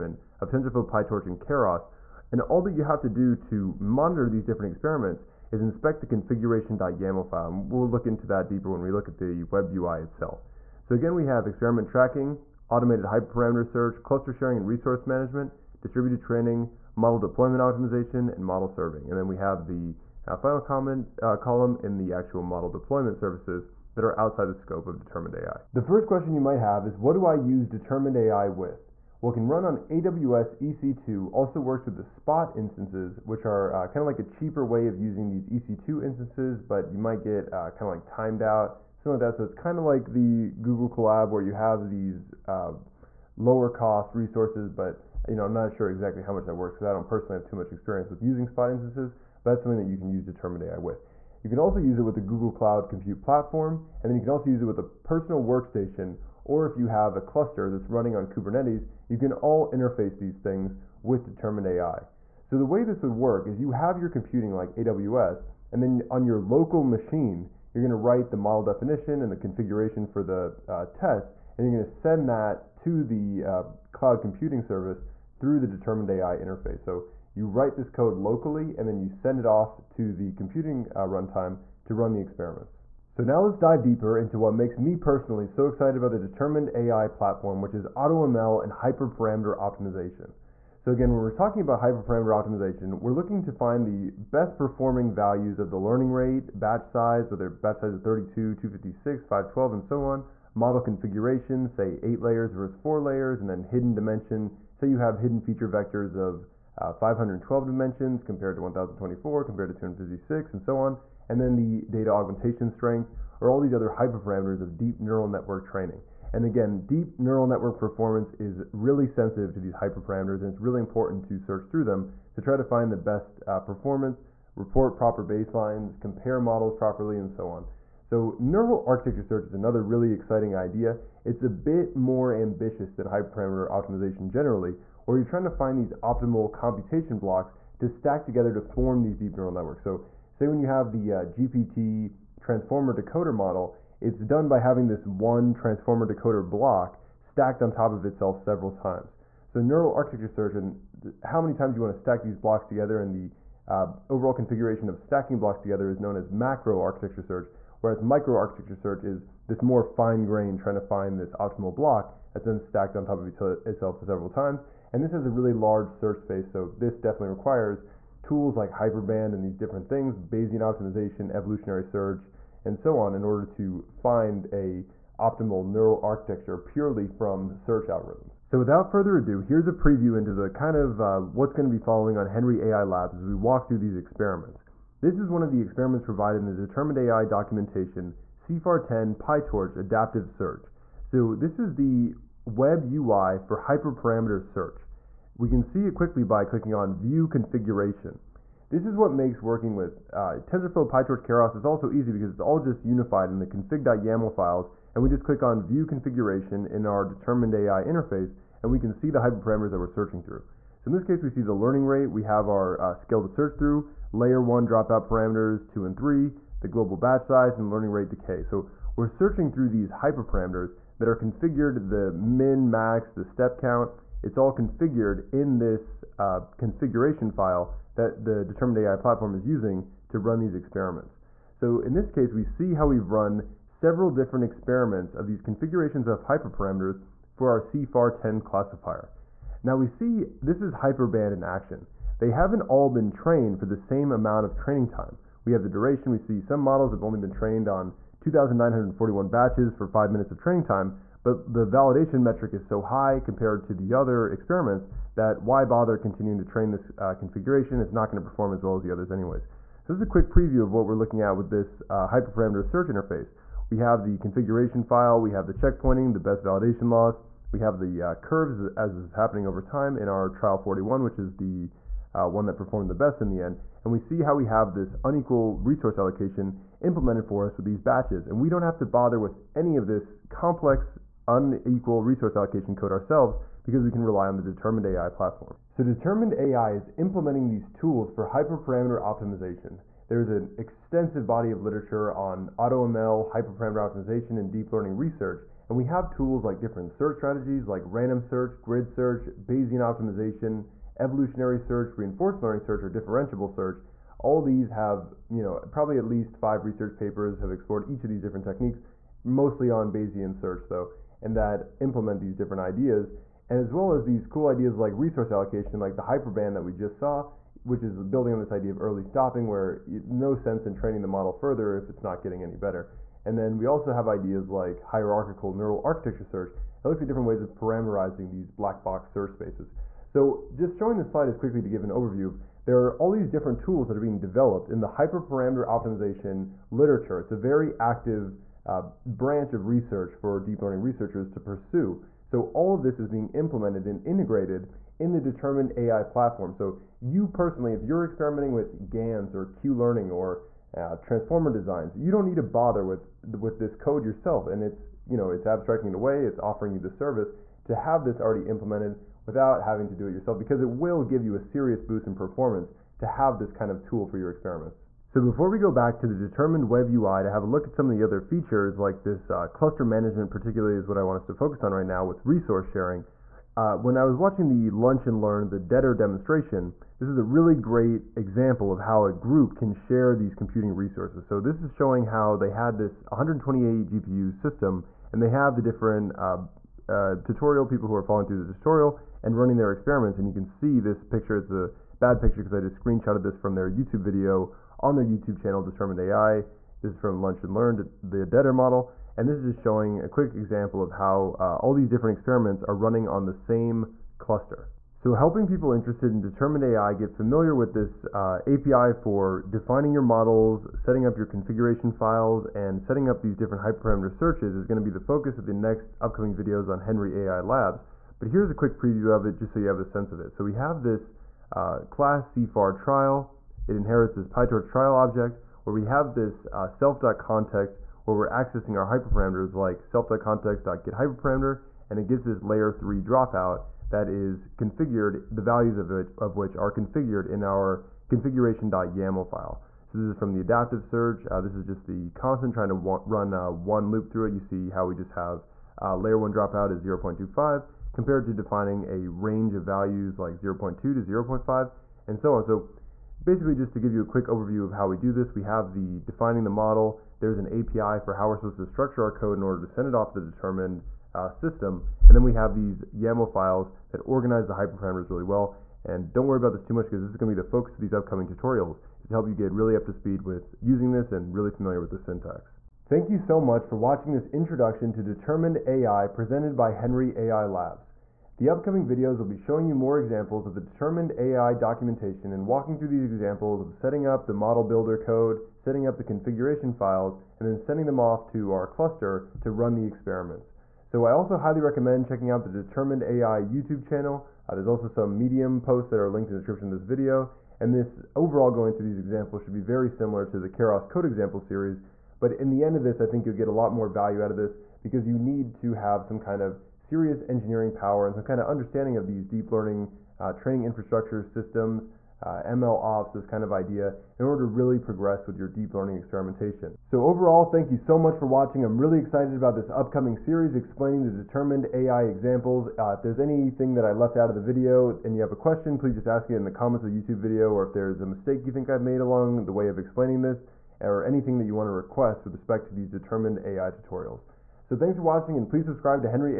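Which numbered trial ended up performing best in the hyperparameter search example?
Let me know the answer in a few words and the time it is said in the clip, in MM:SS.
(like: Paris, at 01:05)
Trial 41, at 04:30.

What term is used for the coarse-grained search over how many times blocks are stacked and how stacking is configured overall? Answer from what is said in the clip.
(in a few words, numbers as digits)
Macro architecture search.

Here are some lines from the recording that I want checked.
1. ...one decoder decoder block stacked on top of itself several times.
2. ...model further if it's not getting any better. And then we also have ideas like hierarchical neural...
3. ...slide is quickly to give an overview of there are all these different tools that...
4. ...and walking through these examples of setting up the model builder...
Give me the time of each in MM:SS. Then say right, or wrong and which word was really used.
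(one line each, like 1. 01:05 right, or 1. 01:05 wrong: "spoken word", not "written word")
1. 02:25 wrong: "transformer", not "decoder"
2. 05:21 right
3. 05:31 right
4. 08:02 right.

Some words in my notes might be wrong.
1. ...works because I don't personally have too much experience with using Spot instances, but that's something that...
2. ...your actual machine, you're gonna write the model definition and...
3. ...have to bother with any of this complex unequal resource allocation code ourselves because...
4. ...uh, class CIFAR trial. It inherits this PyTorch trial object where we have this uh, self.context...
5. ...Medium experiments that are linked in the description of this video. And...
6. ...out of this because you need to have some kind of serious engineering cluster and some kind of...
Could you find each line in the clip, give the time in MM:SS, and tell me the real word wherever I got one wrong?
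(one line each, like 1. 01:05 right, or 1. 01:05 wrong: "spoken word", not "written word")
1. 00:46 right
2. 01:06 wrong: "local", not "actual"
3. 04:38 right
4. 07:01 right
5. 08:15 wrong: "posts", not "experiments"
6. 08:24 wrong: "power", not "cluster".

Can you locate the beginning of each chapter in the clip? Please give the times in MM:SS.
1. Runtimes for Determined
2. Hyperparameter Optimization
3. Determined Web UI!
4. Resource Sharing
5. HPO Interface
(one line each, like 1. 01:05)
1. 00:25
2. 01:21
3. 02:56
4. 06:01
5. 06:44.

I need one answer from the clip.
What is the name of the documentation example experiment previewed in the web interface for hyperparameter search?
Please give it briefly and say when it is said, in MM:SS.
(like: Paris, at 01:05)
CIFAR 10 PyTorch Adaptive Search, at 03:08.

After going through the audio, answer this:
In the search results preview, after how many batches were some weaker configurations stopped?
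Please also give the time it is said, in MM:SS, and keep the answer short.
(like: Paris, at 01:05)
2,941, at 04:08.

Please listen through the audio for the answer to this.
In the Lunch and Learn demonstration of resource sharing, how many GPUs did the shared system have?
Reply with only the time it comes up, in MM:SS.
06:23.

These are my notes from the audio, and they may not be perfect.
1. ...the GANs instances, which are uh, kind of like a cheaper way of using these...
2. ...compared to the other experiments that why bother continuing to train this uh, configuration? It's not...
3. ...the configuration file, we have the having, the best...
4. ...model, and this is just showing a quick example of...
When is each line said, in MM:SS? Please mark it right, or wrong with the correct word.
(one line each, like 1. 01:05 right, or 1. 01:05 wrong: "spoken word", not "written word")
1. 00:31 wrong: "Spot", not "GANs"
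2. 04:13 right
3. 04:24 wrong: "checkpointing", not "having"
4. 06:38 right.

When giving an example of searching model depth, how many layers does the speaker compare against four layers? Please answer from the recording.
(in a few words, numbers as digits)
8.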